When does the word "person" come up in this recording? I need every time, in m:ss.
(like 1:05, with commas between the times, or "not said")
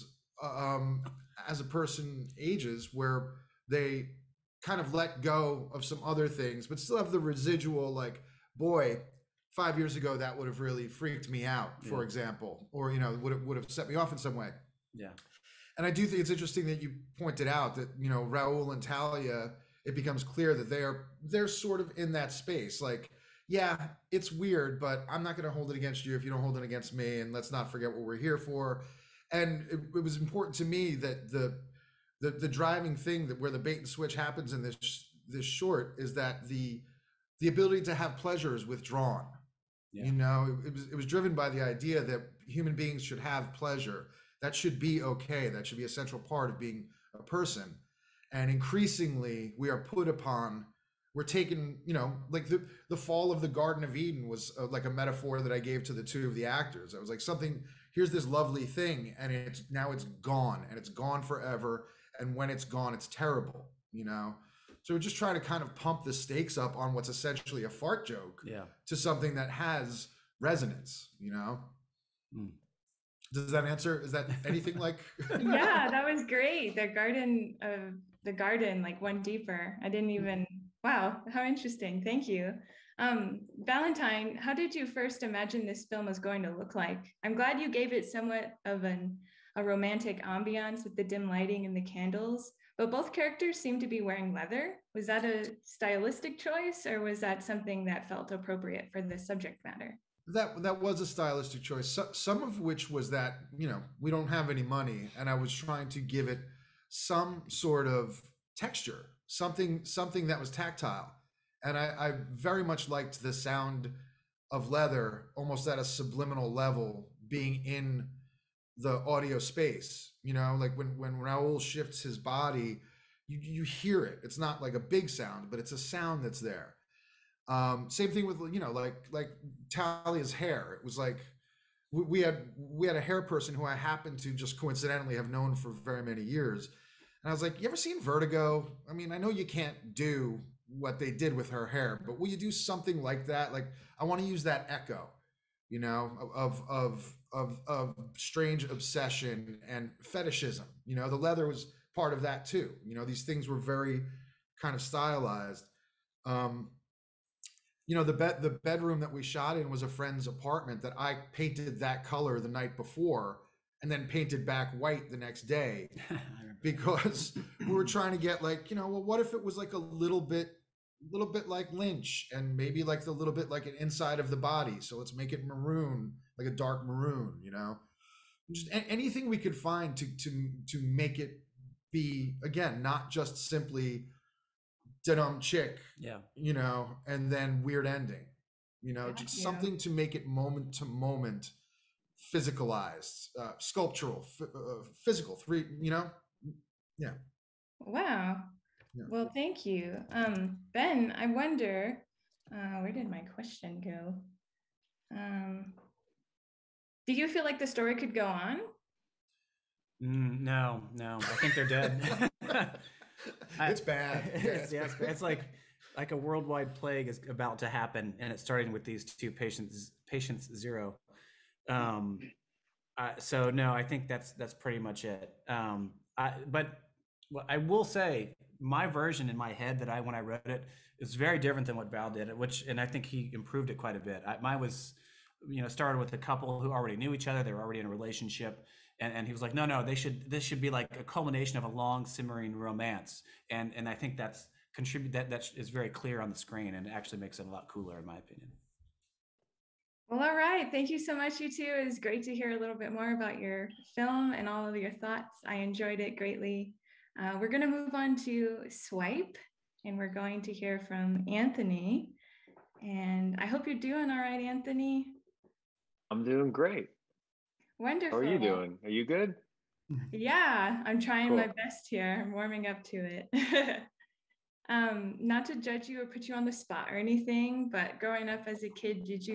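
0:01, 0:47, 2:13.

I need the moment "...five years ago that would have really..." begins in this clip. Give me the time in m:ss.
0:09.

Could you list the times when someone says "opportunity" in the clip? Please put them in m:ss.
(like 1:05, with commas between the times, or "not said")
not said.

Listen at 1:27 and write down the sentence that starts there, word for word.
I'm glad you gave it somewhat of an a romantic ambiance with the dim lighting and the candles.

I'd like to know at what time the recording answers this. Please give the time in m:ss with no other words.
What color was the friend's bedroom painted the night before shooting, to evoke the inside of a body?
2:56.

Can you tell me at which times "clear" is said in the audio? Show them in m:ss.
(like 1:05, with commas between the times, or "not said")
0:20, 4:05.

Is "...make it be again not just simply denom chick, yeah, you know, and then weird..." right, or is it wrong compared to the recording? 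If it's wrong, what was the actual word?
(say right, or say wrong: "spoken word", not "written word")
right.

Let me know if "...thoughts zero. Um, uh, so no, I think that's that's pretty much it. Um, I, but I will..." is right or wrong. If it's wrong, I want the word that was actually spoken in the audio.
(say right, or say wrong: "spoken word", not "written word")
wrong: "patients", not "thoughts".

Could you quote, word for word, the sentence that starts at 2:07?
Um, same thing with you know like like Talia's hair.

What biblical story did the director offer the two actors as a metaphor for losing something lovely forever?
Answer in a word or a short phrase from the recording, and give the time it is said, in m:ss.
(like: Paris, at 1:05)
The fall of the Garden of Eden, at 0:52.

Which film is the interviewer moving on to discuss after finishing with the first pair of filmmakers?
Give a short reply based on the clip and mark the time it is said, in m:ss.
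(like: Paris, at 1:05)
Swipe, at 4:18.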